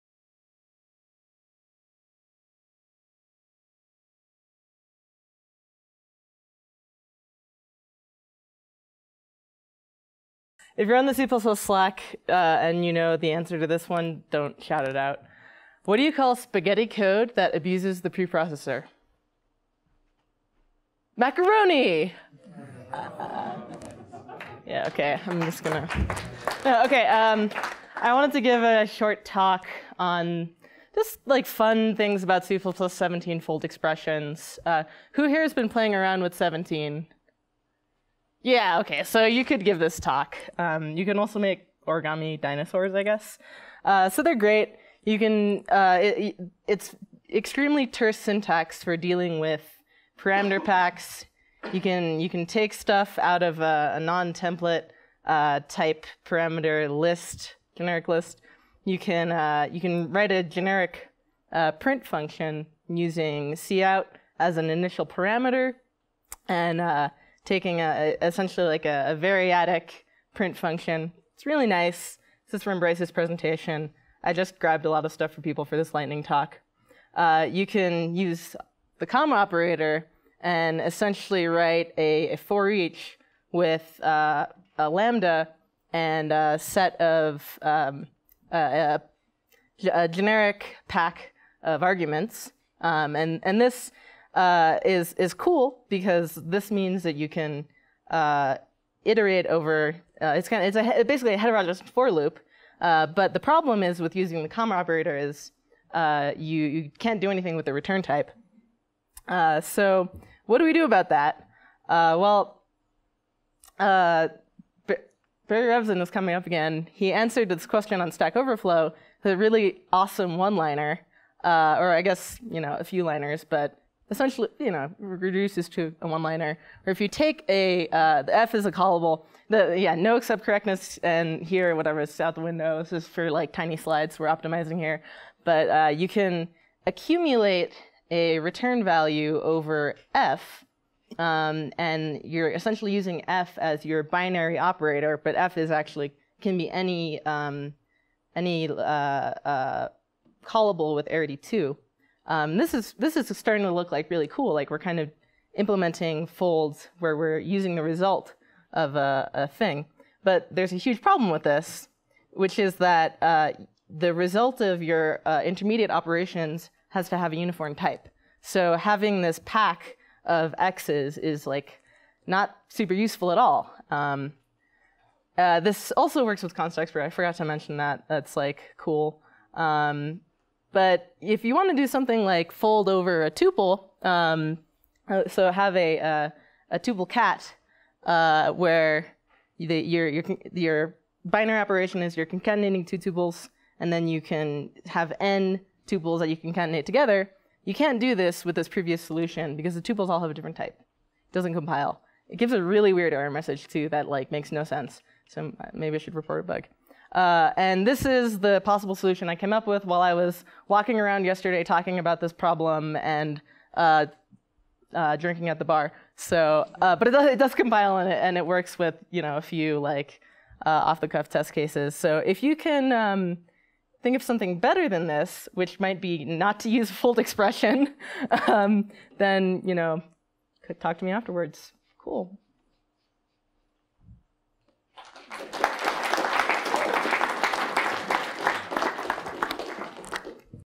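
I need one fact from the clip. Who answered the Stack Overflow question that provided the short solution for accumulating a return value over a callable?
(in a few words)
Barry Revzin.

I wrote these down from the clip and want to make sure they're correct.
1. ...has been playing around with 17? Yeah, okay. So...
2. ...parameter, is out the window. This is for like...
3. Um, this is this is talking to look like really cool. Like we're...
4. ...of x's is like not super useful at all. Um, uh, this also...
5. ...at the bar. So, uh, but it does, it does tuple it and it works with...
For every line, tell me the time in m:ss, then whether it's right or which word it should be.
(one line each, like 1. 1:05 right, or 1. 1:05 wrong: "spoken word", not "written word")
1. 0:35 right
2. 2:11 wrong: "whatever", not "parameter"
3. 2:32 wrong: "starting", not "talking"
4. 2:50 right
5. 3:35 wrong: "compile", not "tuple".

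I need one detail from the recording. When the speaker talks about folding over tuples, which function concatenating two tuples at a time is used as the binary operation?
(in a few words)
tuple cat.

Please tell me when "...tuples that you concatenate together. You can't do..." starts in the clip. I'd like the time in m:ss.
3:15.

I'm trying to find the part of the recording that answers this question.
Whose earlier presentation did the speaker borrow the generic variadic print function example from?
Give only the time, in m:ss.
1:12.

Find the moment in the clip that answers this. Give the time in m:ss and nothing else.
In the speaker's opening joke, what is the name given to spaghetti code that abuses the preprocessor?
0:21.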